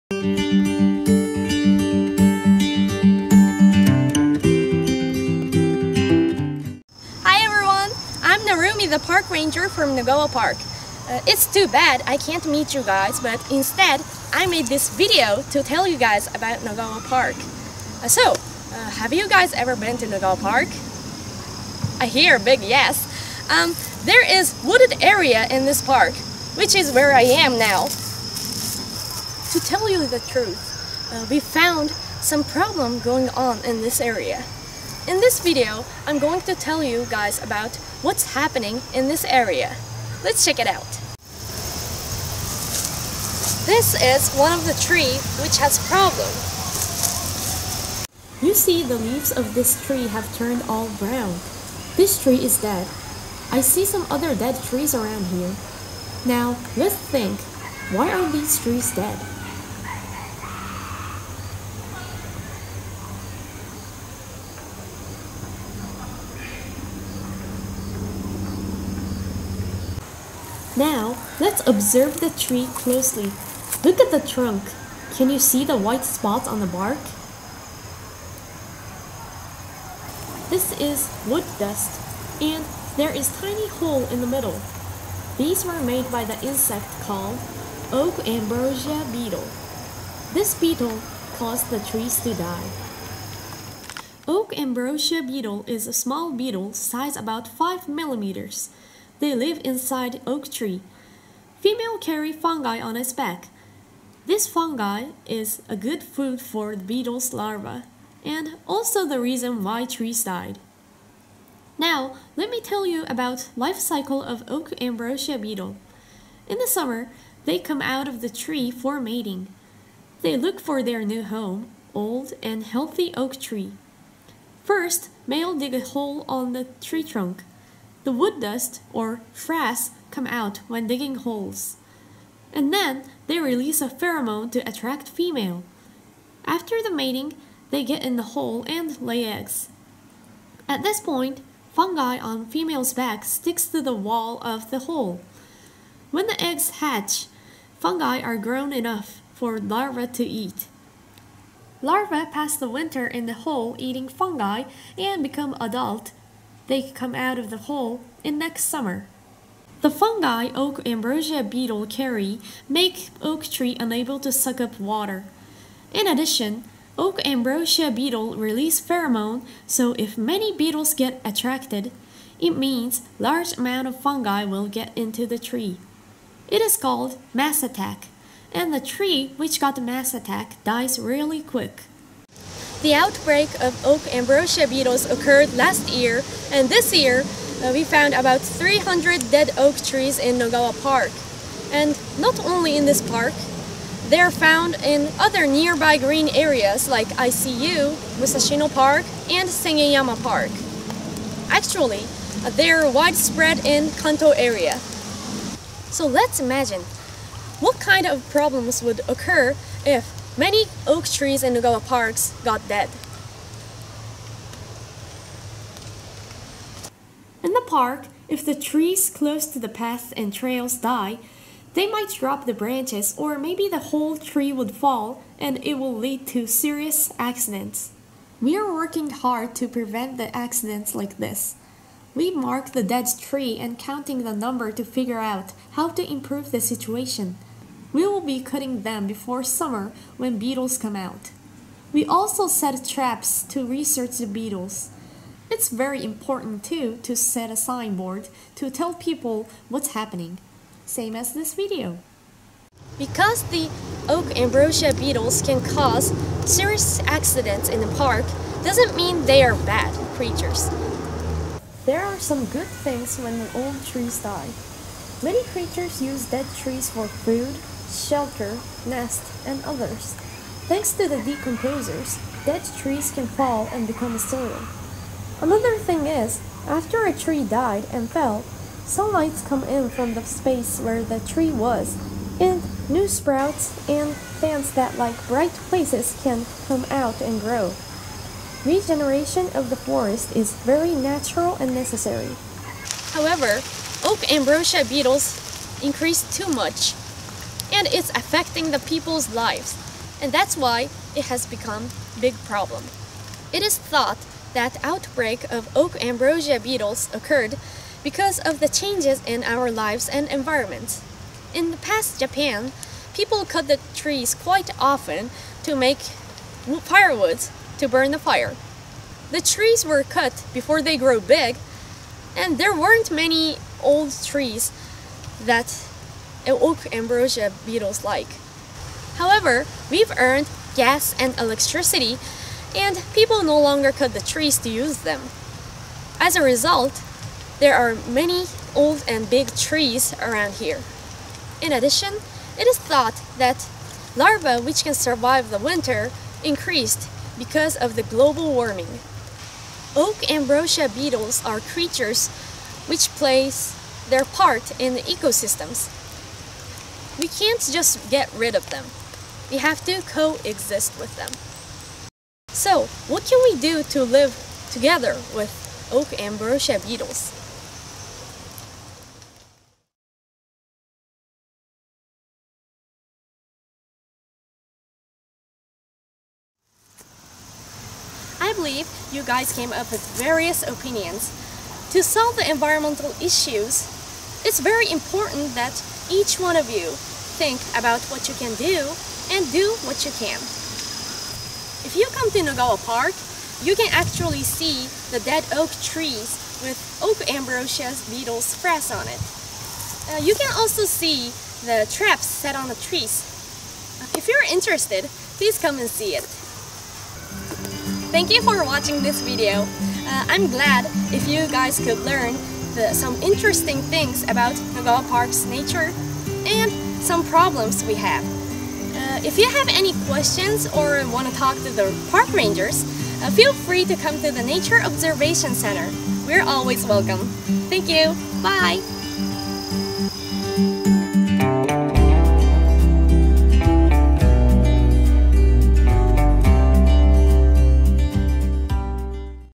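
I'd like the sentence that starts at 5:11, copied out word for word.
In the past Japan, people cut the trees quite often to make firewoods to burn the fire.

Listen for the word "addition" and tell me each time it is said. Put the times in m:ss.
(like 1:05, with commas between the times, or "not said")
2:46, 5:41.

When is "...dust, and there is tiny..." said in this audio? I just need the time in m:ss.
1:21.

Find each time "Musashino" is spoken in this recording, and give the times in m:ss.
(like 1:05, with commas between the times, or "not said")
3:18.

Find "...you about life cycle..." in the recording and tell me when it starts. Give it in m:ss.
1:52.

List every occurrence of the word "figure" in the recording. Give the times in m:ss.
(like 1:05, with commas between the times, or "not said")
3:54.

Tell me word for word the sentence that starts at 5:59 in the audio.
We have to coexist with them.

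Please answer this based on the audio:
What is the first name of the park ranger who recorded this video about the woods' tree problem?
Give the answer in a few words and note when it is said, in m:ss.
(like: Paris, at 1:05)
Narumi, at 0:08.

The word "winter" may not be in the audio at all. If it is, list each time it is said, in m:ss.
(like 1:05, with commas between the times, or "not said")
2:32, 5:45.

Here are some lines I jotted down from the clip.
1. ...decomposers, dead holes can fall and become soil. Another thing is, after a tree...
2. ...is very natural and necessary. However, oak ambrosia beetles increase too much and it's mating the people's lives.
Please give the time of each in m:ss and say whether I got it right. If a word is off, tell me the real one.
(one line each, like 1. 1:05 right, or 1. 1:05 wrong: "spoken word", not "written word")
1. 4:31 wrong: "trees", not "holes"
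2. 4:50 wrong: "affecting", not "mating".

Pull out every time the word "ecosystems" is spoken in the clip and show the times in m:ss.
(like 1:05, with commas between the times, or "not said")
5:55.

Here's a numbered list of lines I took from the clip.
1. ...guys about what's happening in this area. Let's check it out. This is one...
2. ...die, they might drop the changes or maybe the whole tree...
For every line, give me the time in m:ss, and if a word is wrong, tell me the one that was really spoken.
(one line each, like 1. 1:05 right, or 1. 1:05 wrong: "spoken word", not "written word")
1. 0:37 right
2. 3:40 wrong: "branches", not "changes".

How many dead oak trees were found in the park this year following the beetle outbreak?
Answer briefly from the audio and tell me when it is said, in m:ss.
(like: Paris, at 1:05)
300, at 3:08.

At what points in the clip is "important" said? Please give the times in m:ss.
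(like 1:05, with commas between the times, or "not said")
4:06, 6:24.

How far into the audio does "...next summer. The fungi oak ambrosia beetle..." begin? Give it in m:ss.
2:38.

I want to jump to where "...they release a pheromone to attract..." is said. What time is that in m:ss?
2:13.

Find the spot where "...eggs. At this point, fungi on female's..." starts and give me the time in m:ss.
2:19.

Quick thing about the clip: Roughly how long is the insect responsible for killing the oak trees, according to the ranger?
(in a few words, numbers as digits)
5 millimeters.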